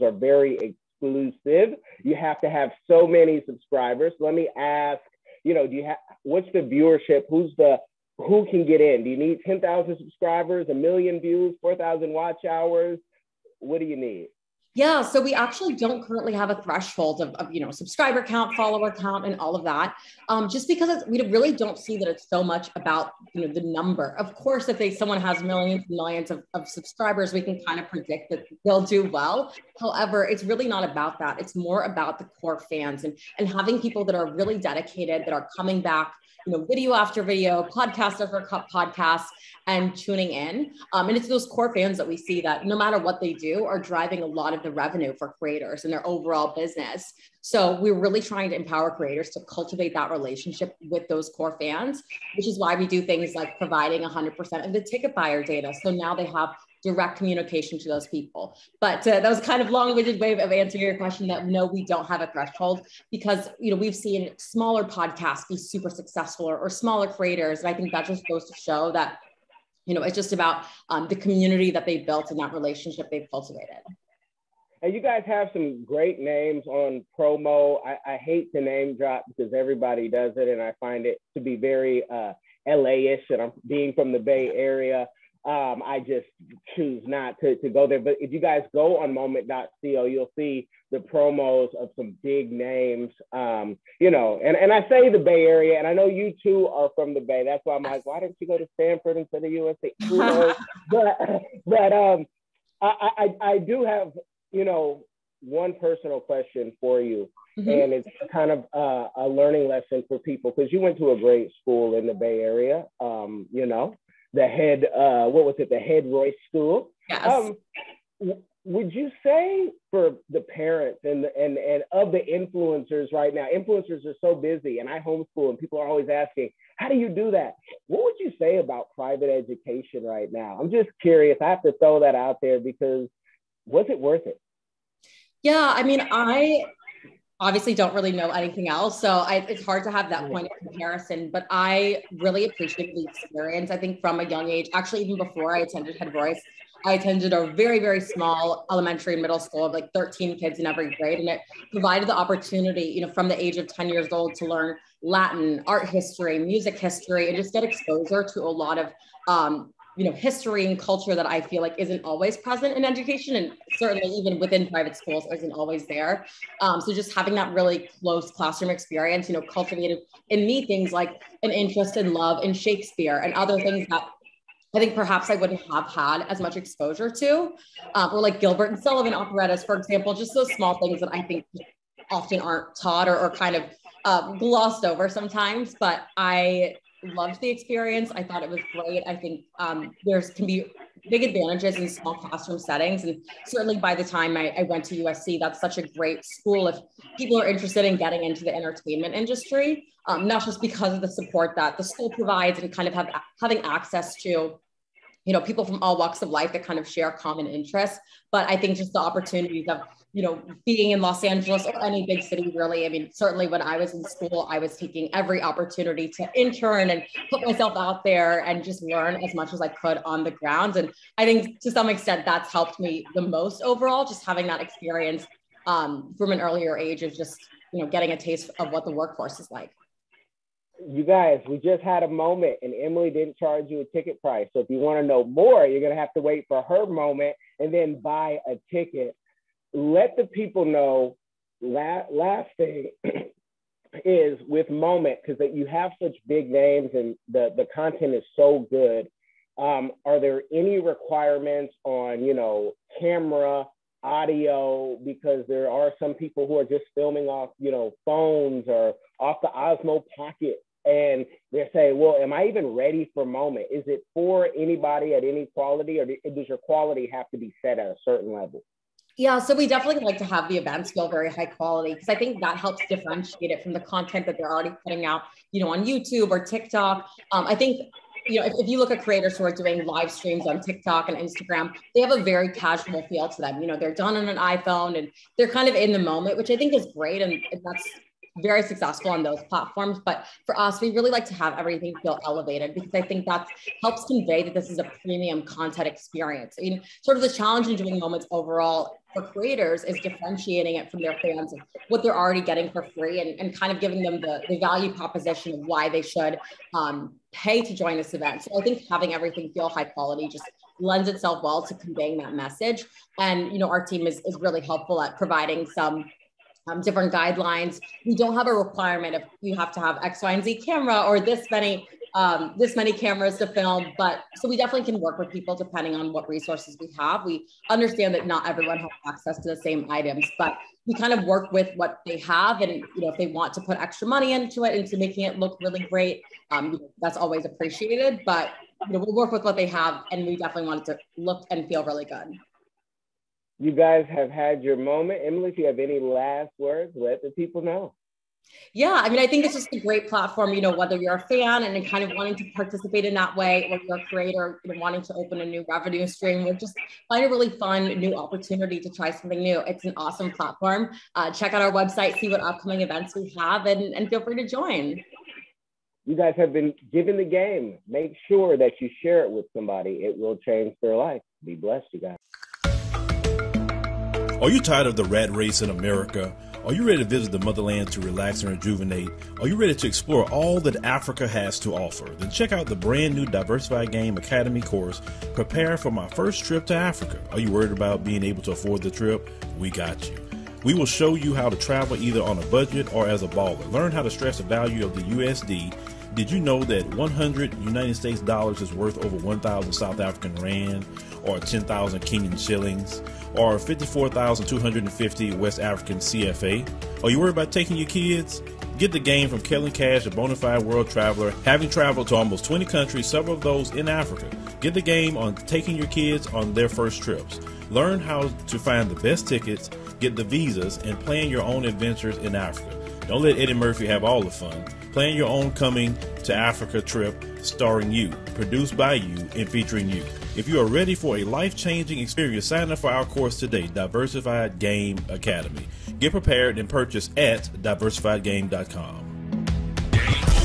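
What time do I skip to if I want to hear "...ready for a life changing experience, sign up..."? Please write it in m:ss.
7:10.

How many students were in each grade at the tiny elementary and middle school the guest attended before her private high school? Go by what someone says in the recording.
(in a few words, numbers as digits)
13.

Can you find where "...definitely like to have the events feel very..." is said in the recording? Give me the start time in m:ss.
4:29.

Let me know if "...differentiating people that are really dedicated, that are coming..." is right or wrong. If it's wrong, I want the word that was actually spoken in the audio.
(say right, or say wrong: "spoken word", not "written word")
wrong: "having", not "differentiating".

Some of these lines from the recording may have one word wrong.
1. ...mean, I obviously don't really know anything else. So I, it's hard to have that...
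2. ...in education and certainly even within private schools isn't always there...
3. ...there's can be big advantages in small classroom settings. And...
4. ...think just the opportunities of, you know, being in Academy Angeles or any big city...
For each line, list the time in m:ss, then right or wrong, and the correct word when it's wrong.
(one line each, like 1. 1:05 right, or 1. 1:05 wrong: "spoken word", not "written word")
1. 2:15 right
2. 2:42 right
3. 3:10 right
4. 3:28 wrong: "Los", not "Academy".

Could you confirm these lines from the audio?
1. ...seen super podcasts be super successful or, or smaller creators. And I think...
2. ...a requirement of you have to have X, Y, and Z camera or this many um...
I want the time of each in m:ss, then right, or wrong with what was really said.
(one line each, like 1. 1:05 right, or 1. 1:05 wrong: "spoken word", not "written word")
1. 1:03 wrong: "smaller", not "super"
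2. 5:18 right.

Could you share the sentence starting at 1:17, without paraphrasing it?
I, I hate to name drop because everybody does it, and I find it to be very uh, LA-ish.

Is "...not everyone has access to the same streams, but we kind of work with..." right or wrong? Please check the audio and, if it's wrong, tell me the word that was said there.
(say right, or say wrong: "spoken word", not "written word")
wrong: "items", not "streams".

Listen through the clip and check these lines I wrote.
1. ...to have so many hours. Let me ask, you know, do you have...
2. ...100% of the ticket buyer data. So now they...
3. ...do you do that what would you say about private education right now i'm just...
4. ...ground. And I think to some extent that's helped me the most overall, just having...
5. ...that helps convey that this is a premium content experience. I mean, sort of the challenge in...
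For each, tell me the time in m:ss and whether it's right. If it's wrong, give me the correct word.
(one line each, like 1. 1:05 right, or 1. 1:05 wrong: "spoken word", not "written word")
1. 0:02 wrong: "subscribers", not "hours"
2. 0:53 right
3. 2:06 right
4. 3:40 right
5. 4:53 right.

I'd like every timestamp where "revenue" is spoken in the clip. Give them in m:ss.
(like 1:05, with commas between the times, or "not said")
0:44, 5:55.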